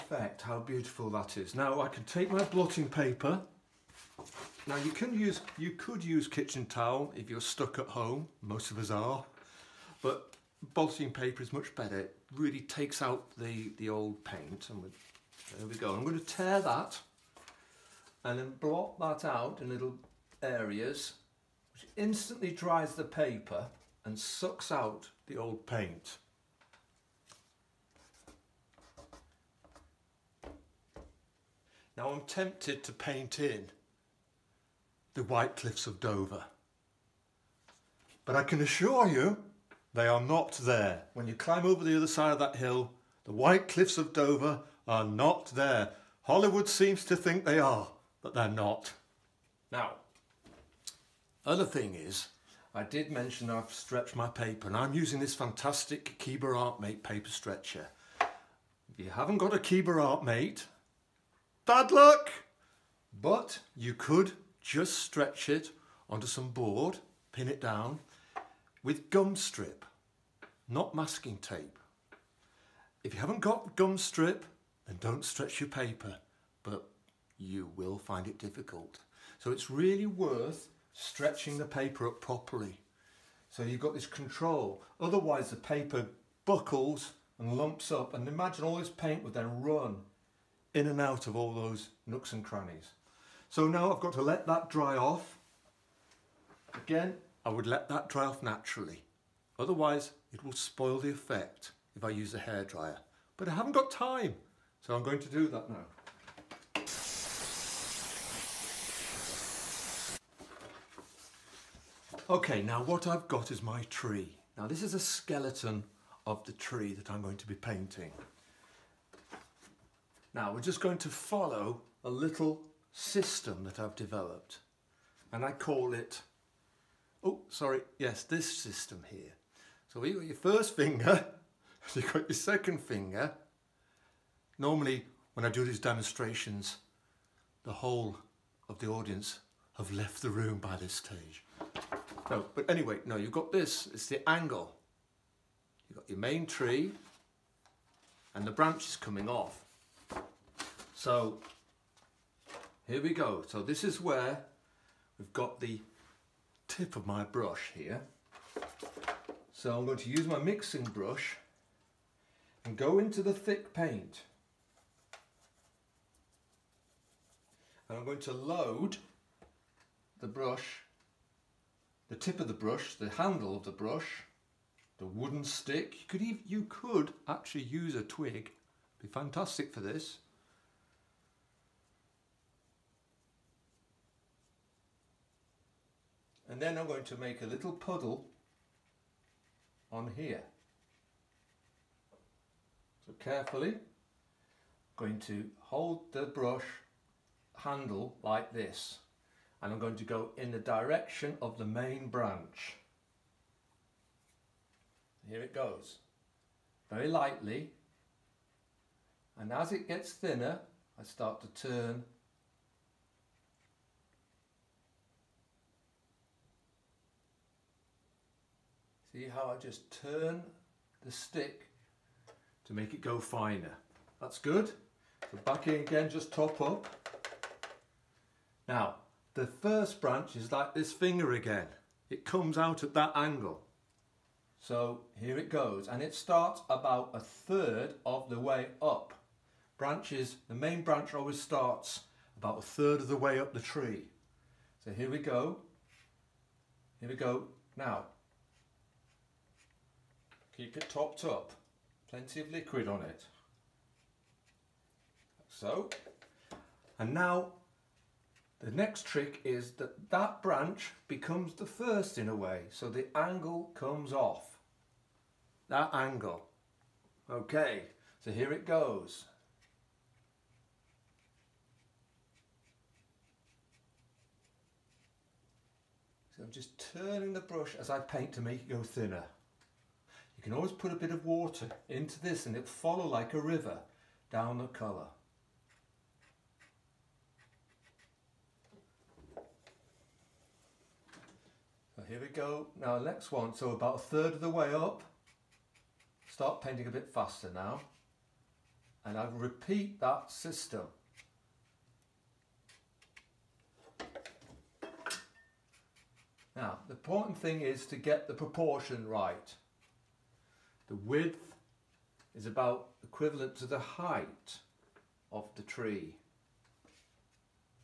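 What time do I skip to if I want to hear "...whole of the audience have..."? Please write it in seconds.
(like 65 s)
137 s.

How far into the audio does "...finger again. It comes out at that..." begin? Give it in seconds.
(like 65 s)
230 s.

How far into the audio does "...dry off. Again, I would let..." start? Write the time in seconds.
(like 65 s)
94 s.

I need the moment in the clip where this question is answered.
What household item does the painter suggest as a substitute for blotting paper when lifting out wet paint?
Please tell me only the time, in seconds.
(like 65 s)
6 s.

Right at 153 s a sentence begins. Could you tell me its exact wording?
So this is where we've got the tip of my brush here.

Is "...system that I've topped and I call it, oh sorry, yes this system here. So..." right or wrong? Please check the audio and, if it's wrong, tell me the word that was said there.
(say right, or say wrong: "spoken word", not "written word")
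wrong: "developed", not "topped".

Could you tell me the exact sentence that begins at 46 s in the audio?
Hollywood seems to think they are, but they're not.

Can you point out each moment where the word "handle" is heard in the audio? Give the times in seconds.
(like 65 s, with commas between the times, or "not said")
173 s, 197 s.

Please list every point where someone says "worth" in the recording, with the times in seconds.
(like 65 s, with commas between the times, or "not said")
80 s.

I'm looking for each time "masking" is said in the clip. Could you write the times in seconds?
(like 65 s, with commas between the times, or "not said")
70 s.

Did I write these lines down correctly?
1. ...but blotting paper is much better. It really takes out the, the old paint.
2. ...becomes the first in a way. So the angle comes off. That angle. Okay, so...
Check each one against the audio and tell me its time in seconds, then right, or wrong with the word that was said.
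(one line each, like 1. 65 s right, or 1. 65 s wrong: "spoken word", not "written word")
1. 10 s right
2. 261 s right.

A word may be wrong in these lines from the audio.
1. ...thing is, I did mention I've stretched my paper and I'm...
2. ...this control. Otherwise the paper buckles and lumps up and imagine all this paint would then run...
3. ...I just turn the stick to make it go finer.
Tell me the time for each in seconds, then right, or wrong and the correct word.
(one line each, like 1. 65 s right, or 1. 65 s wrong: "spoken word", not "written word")
1. 51 s right
2. 83 s right
3. 219 s right.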